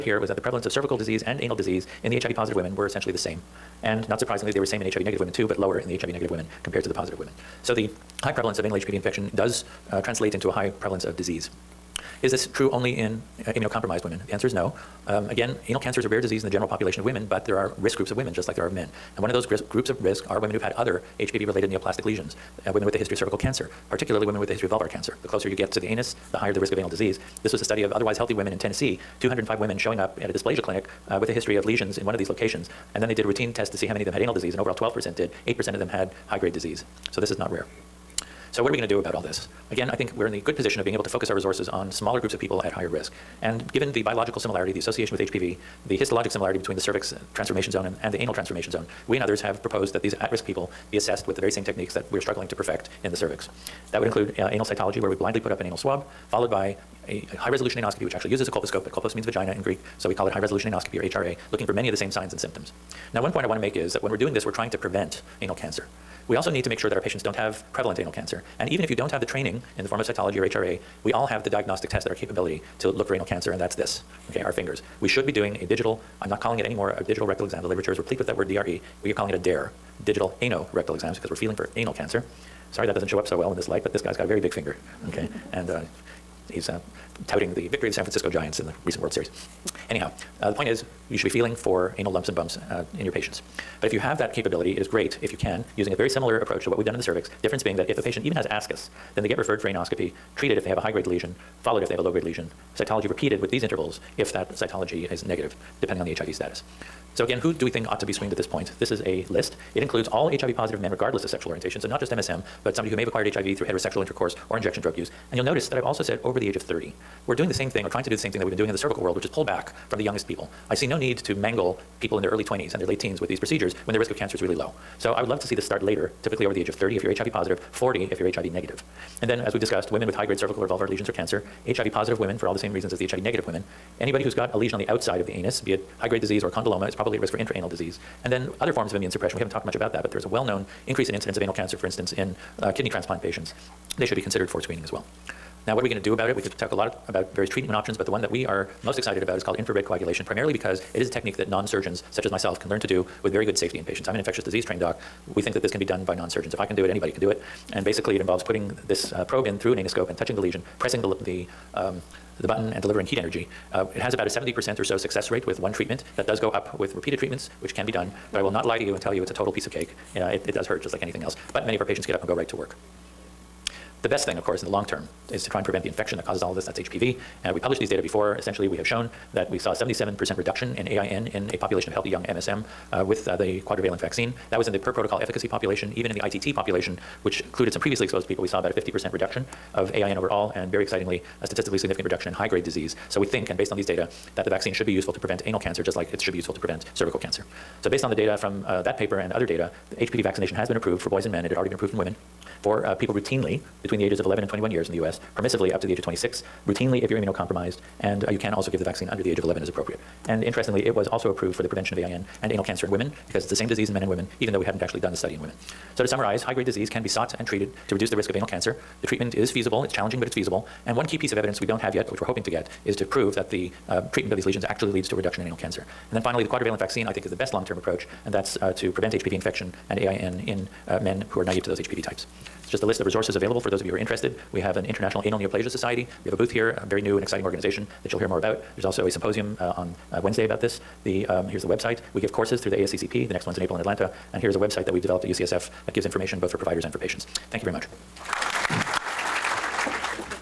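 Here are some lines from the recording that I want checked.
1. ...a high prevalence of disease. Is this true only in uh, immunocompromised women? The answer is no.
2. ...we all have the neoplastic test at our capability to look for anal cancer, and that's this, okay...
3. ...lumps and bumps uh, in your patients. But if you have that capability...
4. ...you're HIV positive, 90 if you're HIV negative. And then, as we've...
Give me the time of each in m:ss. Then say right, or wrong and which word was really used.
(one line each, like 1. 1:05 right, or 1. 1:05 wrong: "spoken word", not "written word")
1. 0:10 right
2. 1:11 wrong: "diagnostic", not "neoplastic"
3. 1:32 right
4. 2:07 wrong: "40", not "90".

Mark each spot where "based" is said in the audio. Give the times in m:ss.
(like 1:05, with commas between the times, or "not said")
3:13, 3:17.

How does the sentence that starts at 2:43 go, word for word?
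Uh, it has about a 70% or so success rate with one treatment.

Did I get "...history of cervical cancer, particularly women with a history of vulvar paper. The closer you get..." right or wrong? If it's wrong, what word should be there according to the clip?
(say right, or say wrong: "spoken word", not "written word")
wrong: "cancer", not "paper".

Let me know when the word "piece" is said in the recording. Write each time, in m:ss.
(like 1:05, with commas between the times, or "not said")
2:49, 3:41.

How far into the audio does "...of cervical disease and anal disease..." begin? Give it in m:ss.
0:00.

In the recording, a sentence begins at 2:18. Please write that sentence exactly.
And then other forms of immune suppression.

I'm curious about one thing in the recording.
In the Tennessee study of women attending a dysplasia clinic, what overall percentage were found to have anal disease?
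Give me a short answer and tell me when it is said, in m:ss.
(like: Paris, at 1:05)
12%, at 0:34.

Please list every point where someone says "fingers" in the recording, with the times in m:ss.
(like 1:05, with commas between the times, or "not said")
1:14, 1:24.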